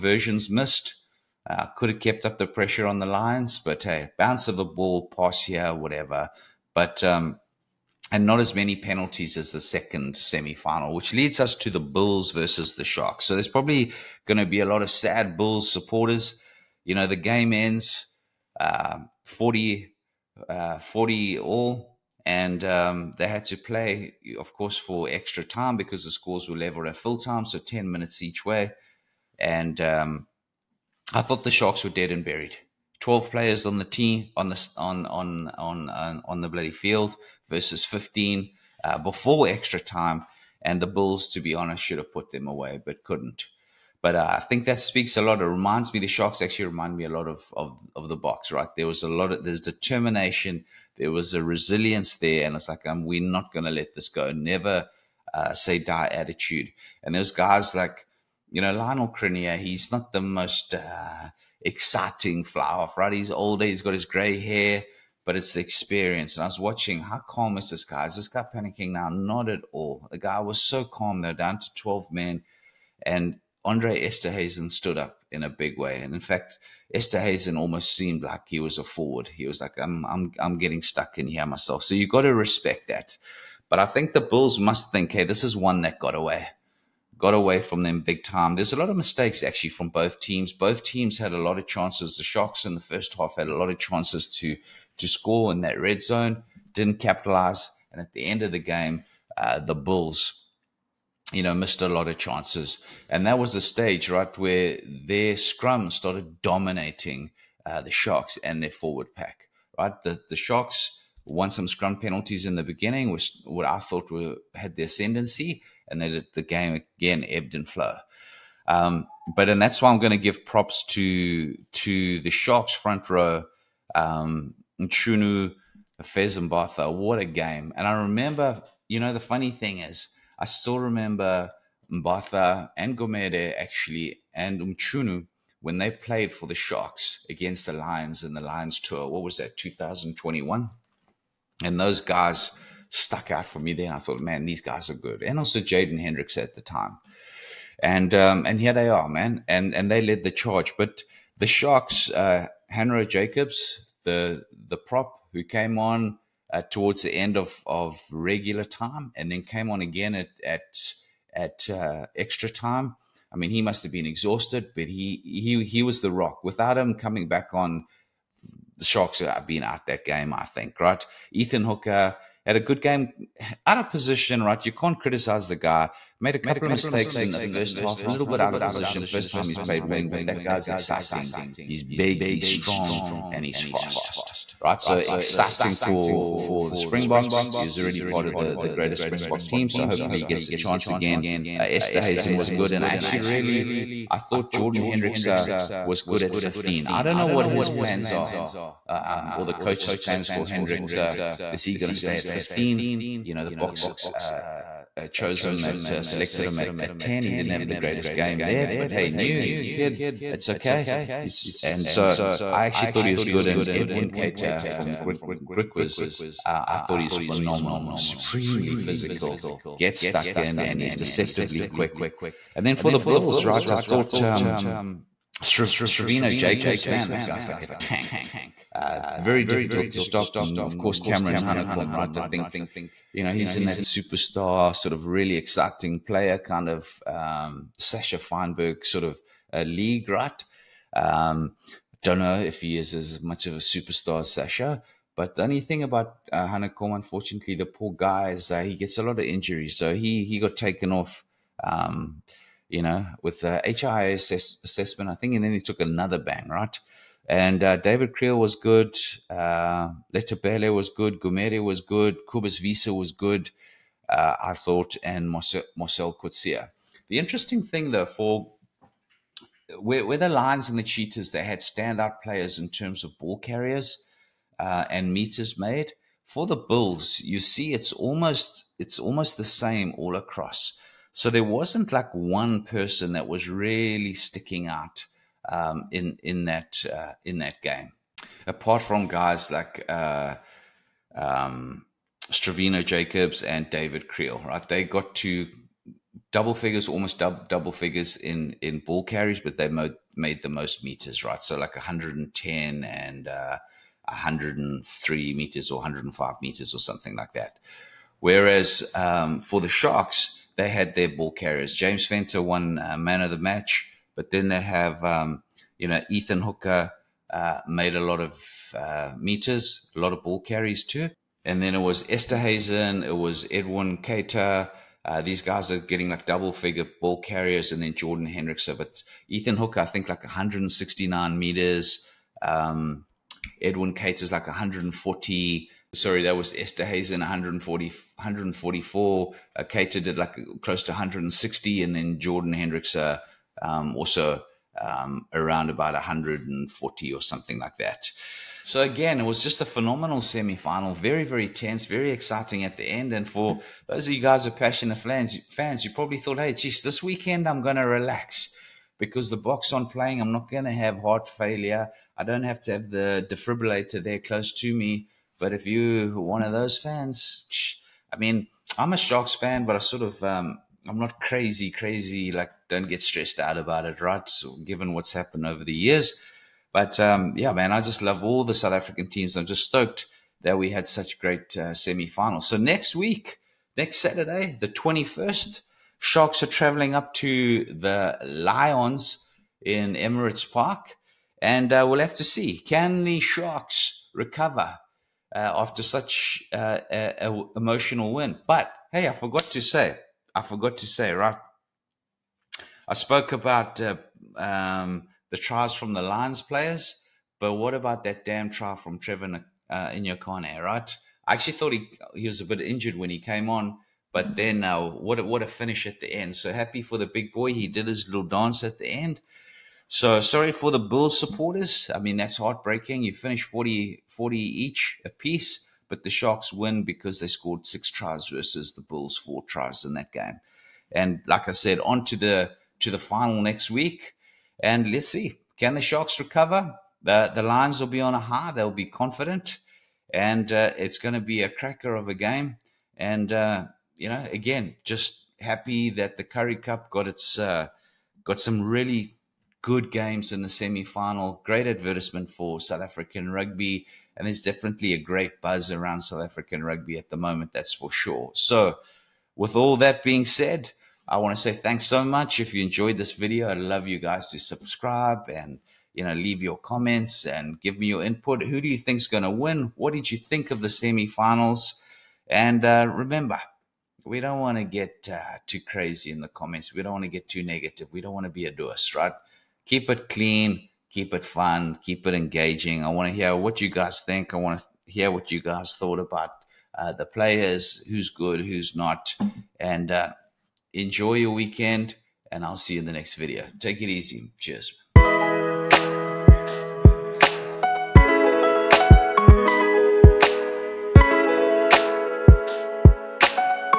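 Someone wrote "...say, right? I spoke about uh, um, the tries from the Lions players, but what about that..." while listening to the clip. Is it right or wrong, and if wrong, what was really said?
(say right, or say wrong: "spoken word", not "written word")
right.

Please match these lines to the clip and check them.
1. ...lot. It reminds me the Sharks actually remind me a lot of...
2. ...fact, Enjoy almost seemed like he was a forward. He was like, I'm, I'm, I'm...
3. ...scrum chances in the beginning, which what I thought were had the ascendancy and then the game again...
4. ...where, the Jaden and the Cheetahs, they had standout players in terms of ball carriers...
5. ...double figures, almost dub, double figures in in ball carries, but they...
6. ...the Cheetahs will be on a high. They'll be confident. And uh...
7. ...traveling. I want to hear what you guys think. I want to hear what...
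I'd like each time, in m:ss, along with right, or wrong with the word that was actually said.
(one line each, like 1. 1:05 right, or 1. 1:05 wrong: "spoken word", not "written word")
1. 0:45 right
2. 1:16 wrong: "Esterhuizen", not "Enjoy"
3. 1:51 wrong: "penalties", not "chances"
4. 4:30 wrong: "Lions", not "Jaden"
5. 4:56 right
6. 7:17 wrong: "Lions", not "Cheetahs"
7. 8:02 wrong: "engaging", not "traveling".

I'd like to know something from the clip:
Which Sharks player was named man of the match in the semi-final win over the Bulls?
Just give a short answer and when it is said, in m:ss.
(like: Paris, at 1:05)
James Venter, at 5:11.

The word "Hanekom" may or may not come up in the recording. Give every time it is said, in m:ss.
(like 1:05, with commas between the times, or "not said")
3:51, 4:06.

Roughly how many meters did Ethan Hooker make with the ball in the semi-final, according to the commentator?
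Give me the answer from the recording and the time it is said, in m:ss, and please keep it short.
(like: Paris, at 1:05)
169, at 5:30.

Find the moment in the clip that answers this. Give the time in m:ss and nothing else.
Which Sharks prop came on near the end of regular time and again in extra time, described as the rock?
2:32.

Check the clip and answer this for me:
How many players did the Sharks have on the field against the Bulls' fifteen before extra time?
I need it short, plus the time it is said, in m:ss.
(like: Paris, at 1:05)
12, at 0:32.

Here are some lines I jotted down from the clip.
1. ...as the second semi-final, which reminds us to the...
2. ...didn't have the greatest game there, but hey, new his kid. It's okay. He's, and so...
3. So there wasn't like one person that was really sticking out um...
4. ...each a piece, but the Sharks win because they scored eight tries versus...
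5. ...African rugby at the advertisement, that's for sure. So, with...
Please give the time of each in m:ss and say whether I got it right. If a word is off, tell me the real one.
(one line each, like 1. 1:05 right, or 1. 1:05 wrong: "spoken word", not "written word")
1. 0:09 wrong: "leads", not "reminds"
2. 3:27 right
3. 4:41 right
4. 7:04 wrong: "six", not "eight"
5. 7:36 wrong: "moment", not "advertisement".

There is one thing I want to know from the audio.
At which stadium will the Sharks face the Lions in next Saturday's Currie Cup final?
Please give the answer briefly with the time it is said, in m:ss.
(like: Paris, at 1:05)
Emirates Park, at 6:29.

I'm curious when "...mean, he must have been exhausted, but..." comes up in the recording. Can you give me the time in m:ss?
2:43.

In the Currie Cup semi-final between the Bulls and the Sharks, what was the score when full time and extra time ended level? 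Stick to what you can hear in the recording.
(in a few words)
40-40.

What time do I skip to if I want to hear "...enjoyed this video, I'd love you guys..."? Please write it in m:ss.
7:42.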